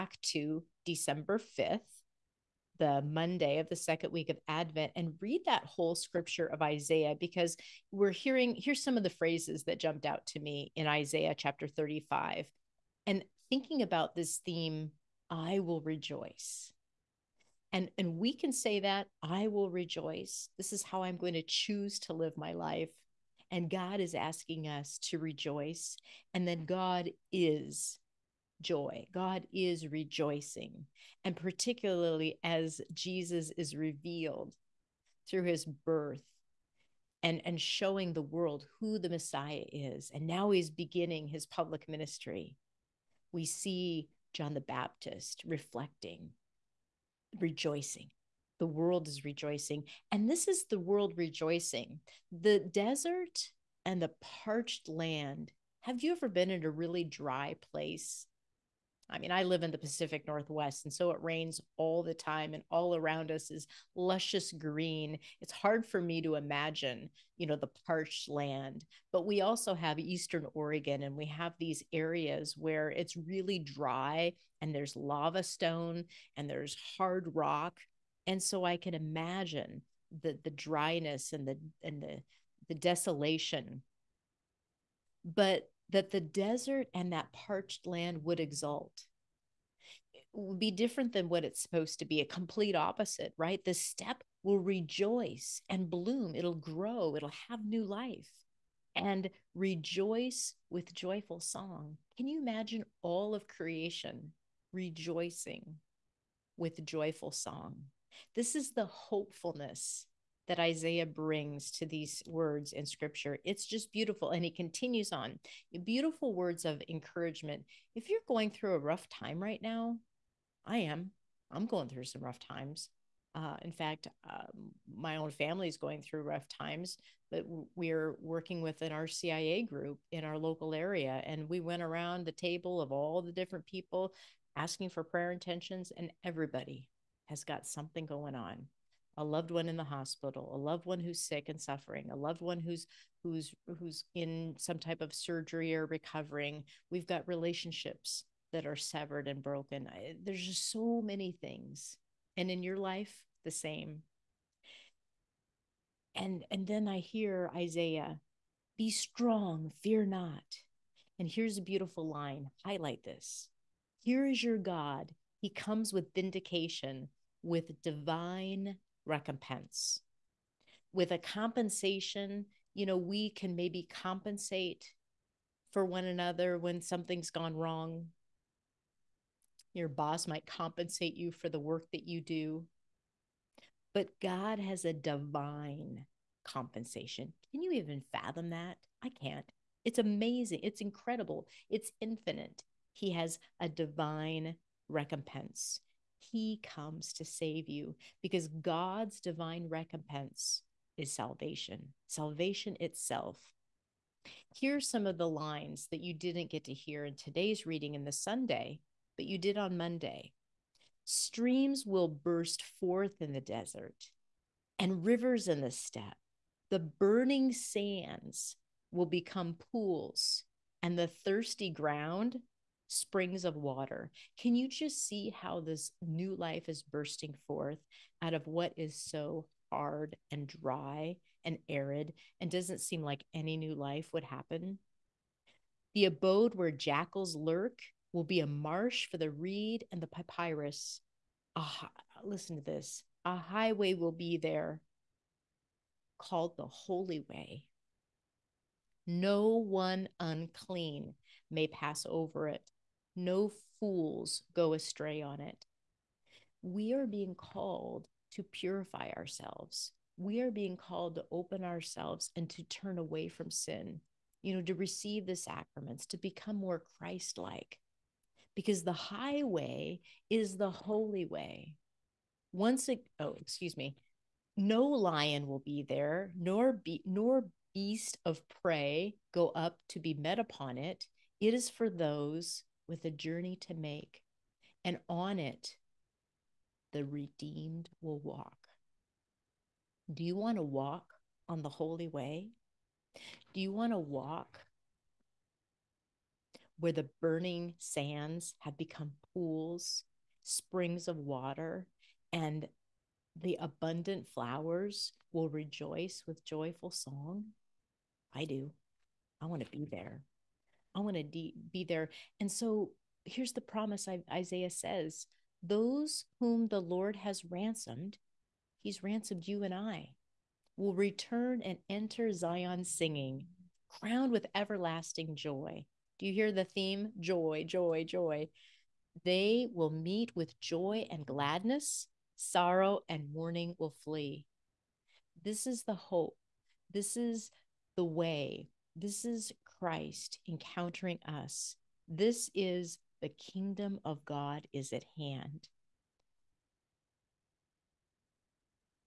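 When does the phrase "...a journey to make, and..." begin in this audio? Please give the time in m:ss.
4:43.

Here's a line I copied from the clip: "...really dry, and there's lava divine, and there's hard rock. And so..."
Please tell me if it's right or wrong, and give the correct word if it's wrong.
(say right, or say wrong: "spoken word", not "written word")
wrong: "stone", not "divine".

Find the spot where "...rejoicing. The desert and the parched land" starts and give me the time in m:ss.
0:51.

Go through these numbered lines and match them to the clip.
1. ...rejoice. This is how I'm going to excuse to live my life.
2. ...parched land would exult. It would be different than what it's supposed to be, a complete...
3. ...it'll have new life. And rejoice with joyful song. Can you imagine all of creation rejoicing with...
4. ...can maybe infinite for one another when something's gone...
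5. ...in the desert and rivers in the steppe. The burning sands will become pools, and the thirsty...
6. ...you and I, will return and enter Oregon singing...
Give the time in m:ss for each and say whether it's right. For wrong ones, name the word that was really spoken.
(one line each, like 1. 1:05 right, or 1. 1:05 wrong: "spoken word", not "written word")
1. 0:19 wrong: "choose", not "excuse"
2. 1:27 right
3. 1:37 right
4. 2:53 wrong: "compensate", not "infinite"
5. 3:33 right
6. 5:19 wrong: "Zion", not "Oregon".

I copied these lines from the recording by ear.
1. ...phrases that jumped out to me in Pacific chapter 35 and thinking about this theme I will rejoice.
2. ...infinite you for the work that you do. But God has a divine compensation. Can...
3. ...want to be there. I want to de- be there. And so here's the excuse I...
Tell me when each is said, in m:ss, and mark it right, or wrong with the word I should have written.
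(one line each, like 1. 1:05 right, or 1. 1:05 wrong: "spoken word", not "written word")
1. 0:09 wrong: "Isaiah", not "Pacific"
2. 3:00 wrong: "compensate", not "infinite"
3. 5:09 wrong: "promise", not "excuse".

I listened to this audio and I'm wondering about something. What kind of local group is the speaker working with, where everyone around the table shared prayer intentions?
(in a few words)
RCIA.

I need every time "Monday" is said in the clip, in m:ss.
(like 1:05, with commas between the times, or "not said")
0:03, 3:29.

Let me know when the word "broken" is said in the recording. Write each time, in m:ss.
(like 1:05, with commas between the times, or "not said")
2:29.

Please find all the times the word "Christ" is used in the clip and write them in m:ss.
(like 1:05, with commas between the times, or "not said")
4:26, 5:39.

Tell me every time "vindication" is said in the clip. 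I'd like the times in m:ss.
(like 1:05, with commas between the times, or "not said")
2:46.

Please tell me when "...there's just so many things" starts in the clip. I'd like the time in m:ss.
2:30.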